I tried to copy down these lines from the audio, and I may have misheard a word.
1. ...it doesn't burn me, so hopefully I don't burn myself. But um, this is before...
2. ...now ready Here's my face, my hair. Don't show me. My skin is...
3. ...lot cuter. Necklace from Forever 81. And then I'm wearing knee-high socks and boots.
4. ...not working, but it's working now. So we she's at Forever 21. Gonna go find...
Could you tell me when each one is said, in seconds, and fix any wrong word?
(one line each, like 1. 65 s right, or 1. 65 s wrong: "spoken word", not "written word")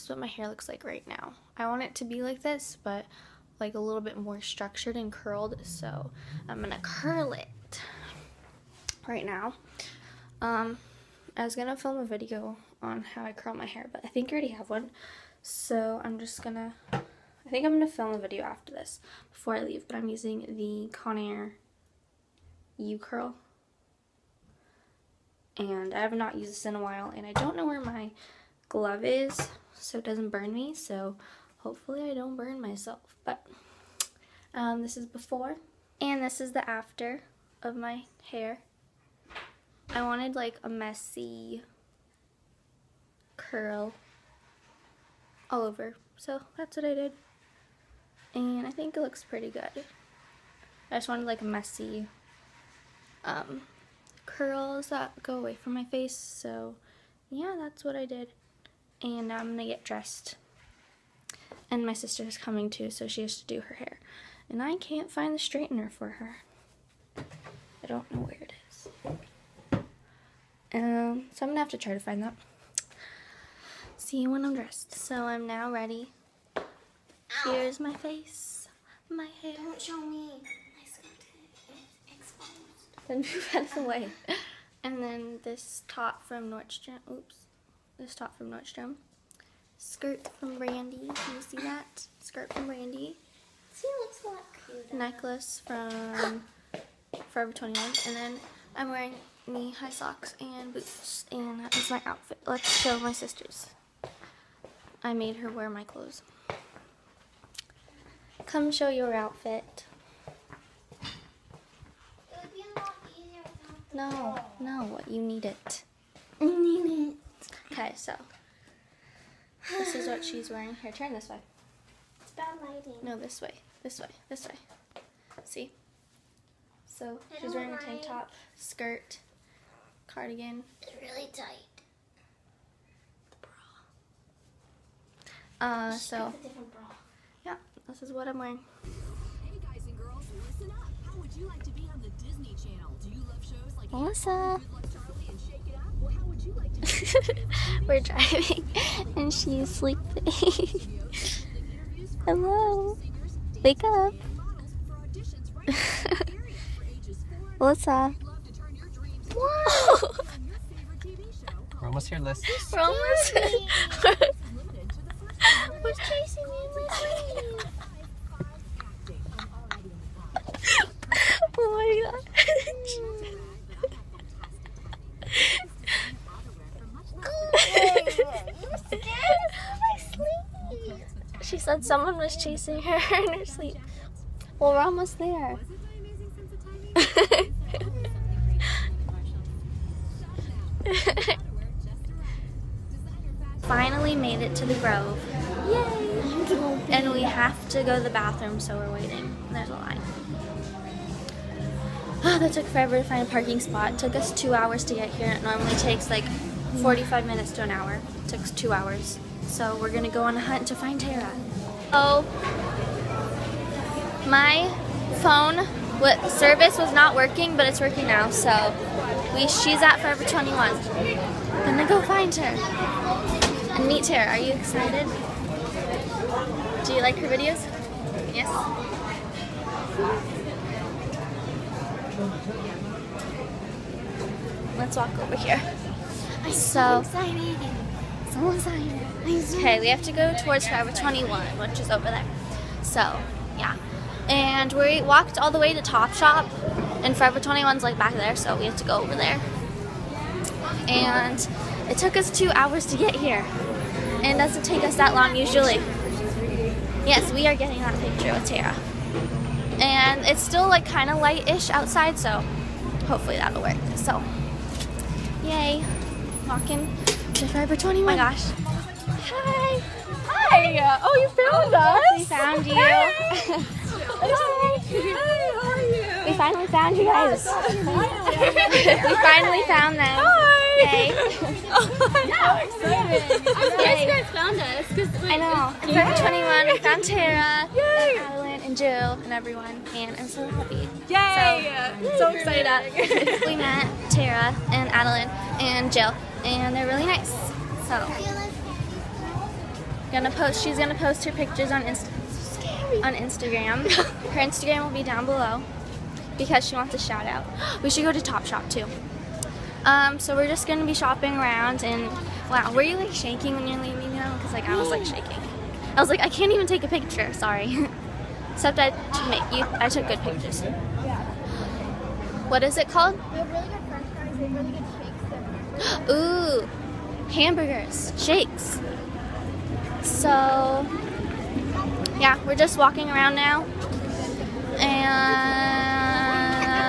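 1. 29 s right
2. 75 s right
3. 94 s wrong: "21", not "81"
4. 216 s right.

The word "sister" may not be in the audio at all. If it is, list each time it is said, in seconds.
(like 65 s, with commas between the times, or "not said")
61 s, 103 s.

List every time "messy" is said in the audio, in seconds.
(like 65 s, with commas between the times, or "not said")
40 s, 51 s.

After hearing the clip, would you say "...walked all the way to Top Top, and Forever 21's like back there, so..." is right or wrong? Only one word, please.
wrong.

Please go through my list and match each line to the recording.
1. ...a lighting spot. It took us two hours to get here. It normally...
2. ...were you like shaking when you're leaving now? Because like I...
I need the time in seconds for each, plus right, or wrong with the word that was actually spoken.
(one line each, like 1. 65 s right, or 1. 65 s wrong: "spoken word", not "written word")
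1. 203 s wrong: "parking", not "lighting"
2. 312 s right.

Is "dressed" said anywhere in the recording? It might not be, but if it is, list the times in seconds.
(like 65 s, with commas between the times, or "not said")
59 s, 74 s.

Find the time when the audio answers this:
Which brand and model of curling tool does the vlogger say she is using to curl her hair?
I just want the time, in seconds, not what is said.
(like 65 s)
20 s.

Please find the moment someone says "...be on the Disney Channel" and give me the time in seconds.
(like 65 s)
141 s.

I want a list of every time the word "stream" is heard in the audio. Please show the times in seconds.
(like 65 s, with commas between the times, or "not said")
not said.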